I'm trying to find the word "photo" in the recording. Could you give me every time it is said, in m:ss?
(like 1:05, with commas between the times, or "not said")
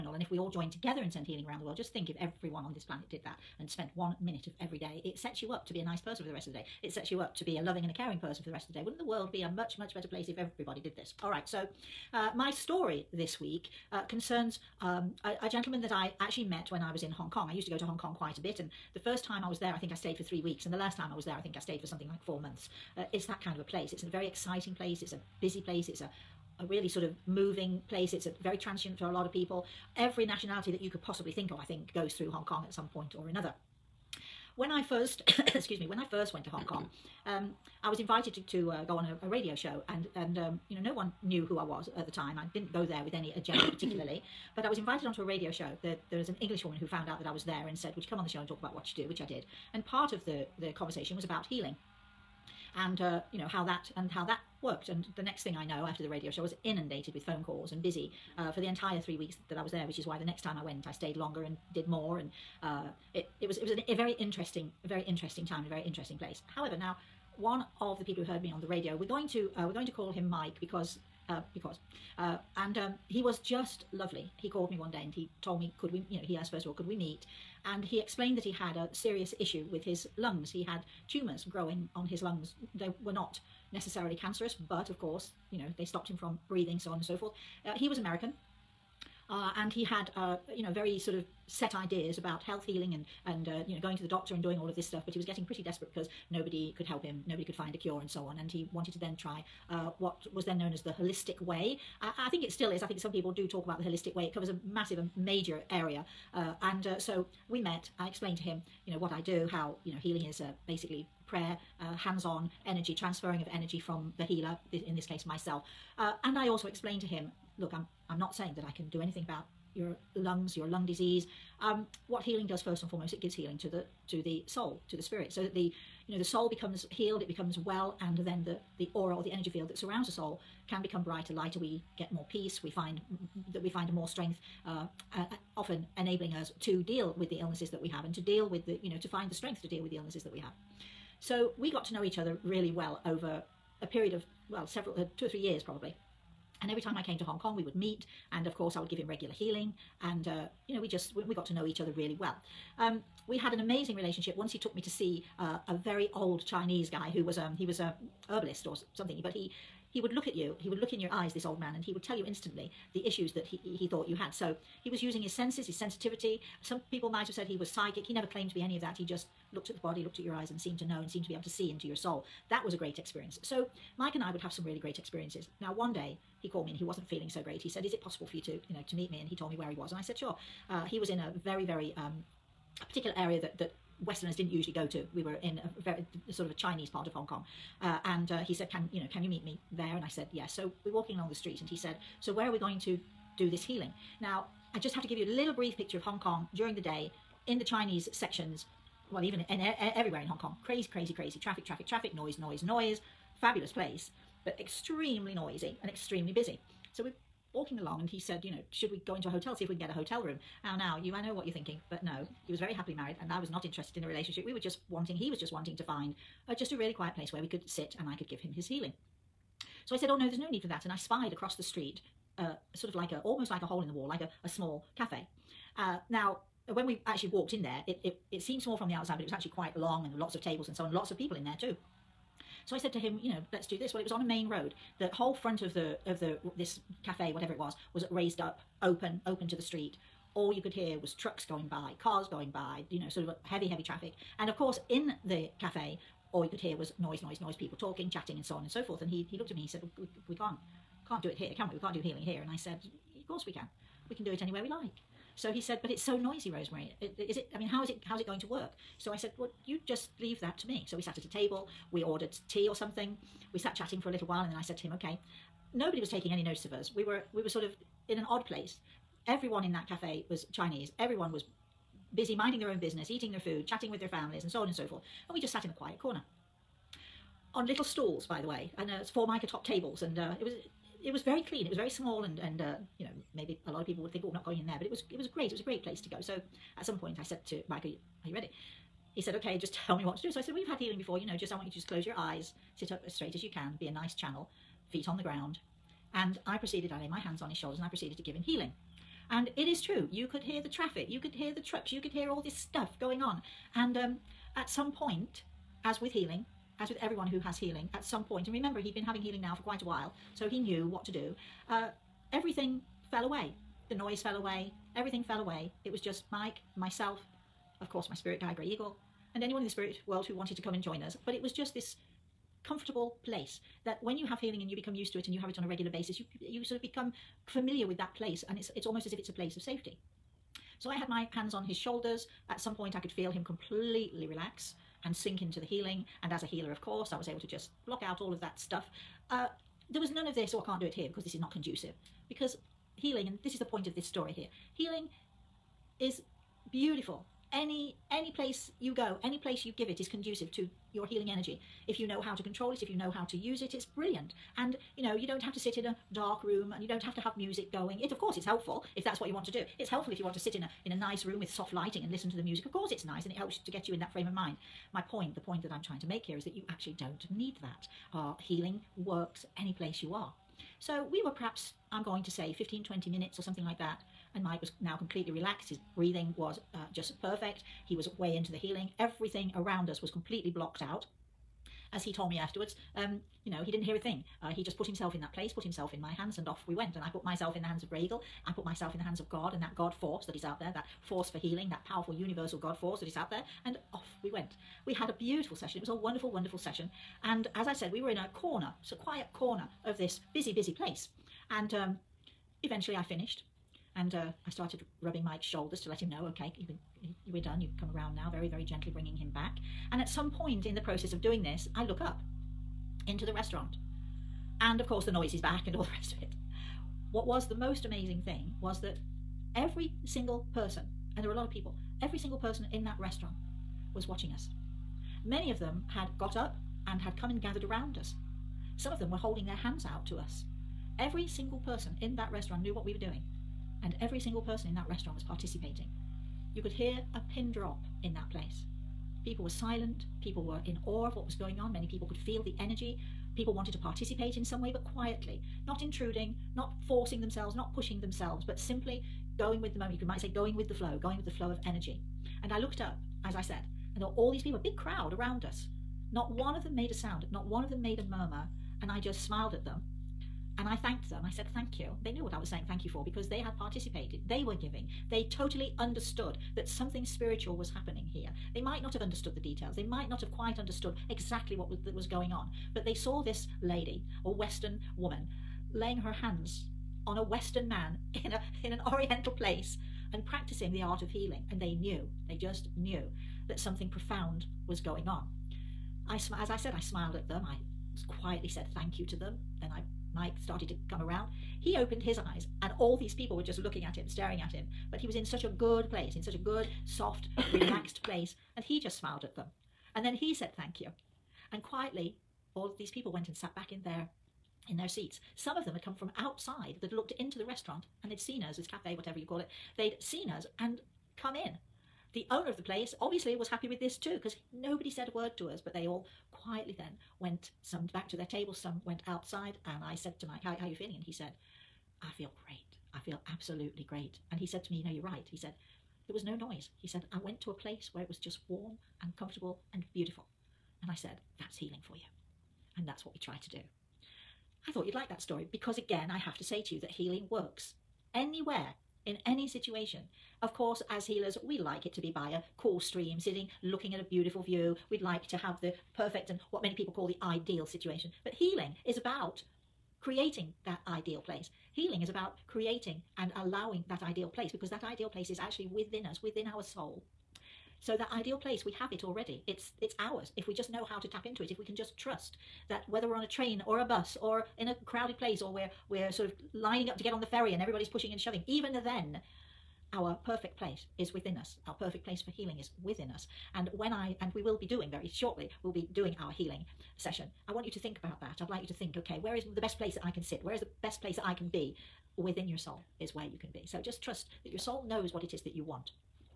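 not said.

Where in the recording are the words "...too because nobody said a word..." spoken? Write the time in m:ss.
8:33.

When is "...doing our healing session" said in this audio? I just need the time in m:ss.
9:35.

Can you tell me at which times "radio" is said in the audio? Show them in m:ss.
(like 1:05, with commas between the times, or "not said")
0:39, 0:45, 0:56, 1:08.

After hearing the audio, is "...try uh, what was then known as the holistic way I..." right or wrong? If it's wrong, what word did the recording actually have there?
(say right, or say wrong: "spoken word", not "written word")
right.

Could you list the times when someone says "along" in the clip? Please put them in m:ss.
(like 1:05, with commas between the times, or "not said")
3:11, 3:27.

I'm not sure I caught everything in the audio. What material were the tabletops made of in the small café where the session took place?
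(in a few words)
mica.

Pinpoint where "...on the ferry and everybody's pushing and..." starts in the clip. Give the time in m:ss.
9:27.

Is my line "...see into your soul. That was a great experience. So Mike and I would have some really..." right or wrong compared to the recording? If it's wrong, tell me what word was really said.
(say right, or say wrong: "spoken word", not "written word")
right.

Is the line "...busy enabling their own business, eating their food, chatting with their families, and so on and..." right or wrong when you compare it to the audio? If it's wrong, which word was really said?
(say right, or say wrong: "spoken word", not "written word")
wrong: "minding", not "enabling".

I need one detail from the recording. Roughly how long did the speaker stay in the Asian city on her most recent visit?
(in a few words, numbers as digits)
4 months.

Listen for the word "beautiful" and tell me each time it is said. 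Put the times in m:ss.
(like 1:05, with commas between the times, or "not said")
5:46, 6:35, 8:49, 9:04.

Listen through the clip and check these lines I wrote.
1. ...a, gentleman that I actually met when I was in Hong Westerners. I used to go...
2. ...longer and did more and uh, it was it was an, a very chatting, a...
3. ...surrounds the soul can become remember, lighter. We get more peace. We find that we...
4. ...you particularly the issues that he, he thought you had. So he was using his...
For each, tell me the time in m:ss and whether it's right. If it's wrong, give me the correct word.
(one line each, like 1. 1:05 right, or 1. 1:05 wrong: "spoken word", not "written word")
1. 0:15 wrong: "Kong", not "Westerners"
2. 1:01 wrong: "interesting", not "chatting"
3. 2:09 wrong: "brighter", not "remember"
4. 2:42 wrong: "instantly", not "particularly".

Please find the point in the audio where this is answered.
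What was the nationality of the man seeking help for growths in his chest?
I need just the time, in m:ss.
1:27.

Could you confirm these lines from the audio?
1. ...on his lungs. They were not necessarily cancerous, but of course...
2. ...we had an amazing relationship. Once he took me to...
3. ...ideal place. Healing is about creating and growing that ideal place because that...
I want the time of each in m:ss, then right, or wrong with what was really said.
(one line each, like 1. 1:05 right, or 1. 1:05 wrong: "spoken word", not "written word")
1. 1:21 right
2. 2:33 right
3. 9:10 wrong: "allowing", not "growing".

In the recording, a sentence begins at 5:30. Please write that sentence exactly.
So I had my hands on his shoulders.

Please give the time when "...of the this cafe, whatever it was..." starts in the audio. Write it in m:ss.
3:56.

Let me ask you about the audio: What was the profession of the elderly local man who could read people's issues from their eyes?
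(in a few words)
herbalist.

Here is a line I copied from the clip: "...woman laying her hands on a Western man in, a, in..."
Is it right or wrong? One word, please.
right.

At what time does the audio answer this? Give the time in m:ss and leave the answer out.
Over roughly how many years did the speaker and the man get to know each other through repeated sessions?
2:25.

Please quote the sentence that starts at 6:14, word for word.
And Mike was now completely relaxed.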